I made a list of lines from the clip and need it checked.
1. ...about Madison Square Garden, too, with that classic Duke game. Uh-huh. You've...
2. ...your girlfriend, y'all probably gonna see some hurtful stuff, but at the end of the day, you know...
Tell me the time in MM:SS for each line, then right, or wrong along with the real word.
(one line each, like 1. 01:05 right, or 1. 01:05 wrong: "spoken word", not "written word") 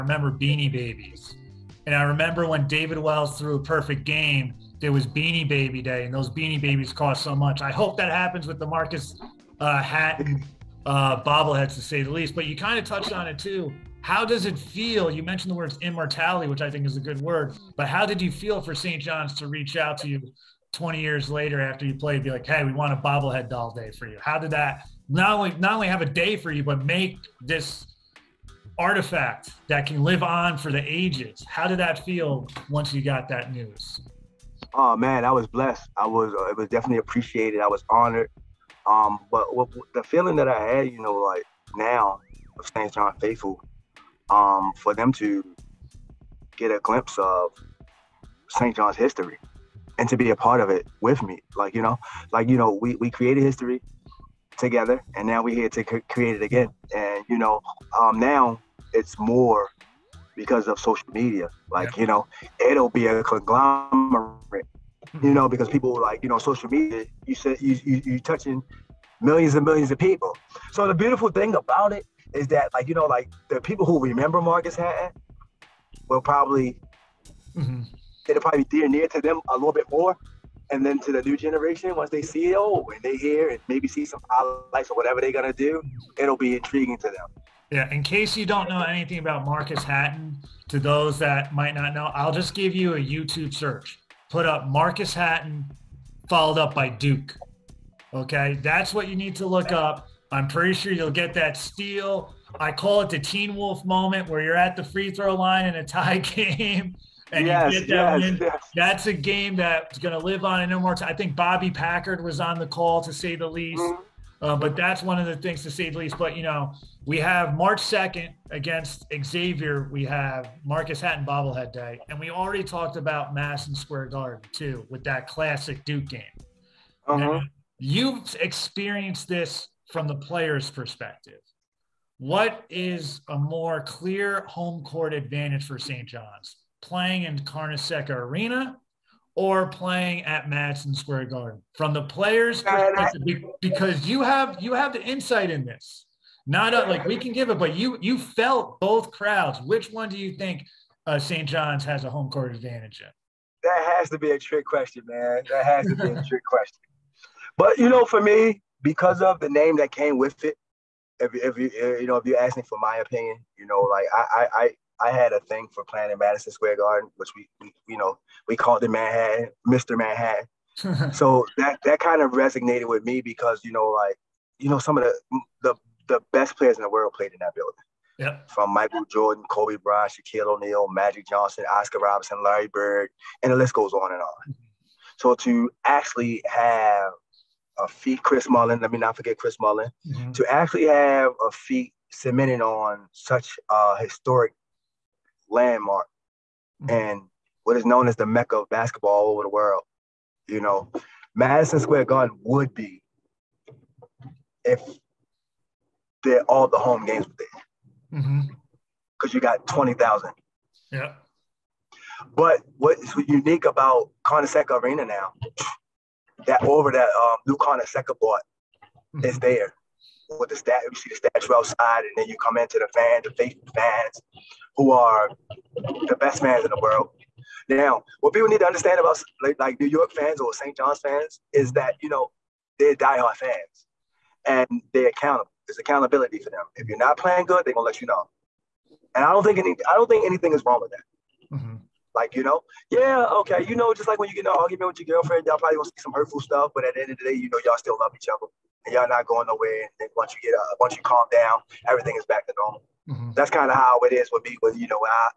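1. 02:02 right
2. 04:05 right.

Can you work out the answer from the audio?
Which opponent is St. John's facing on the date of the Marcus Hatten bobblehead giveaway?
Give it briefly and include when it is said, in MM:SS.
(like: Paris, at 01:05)
Xavier, at 01:59.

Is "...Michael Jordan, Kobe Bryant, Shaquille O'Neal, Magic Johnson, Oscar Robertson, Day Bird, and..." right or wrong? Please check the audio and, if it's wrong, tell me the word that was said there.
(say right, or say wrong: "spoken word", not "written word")
wrong: "Larry", not "Day".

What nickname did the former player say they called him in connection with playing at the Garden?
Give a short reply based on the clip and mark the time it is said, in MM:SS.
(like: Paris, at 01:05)
Mr. Manhattan, at 02:49.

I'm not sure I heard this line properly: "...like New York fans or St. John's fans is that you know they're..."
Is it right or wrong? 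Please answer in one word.
right.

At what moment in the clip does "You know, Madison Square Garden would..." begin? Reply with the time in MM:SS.
03:20.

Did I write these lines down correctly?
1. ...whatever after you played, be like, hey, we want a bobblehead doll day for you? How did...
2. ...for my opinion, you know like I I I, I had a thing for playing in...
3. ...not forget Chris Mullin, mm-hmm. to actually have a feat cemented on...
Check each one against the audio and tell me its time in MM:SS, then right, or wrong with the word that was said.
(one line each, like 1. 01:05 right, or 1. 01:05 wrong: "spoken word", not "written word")
1. 00:21 wrong: "later", not "whatever"
2. 02:42 right
3. 03:08 right.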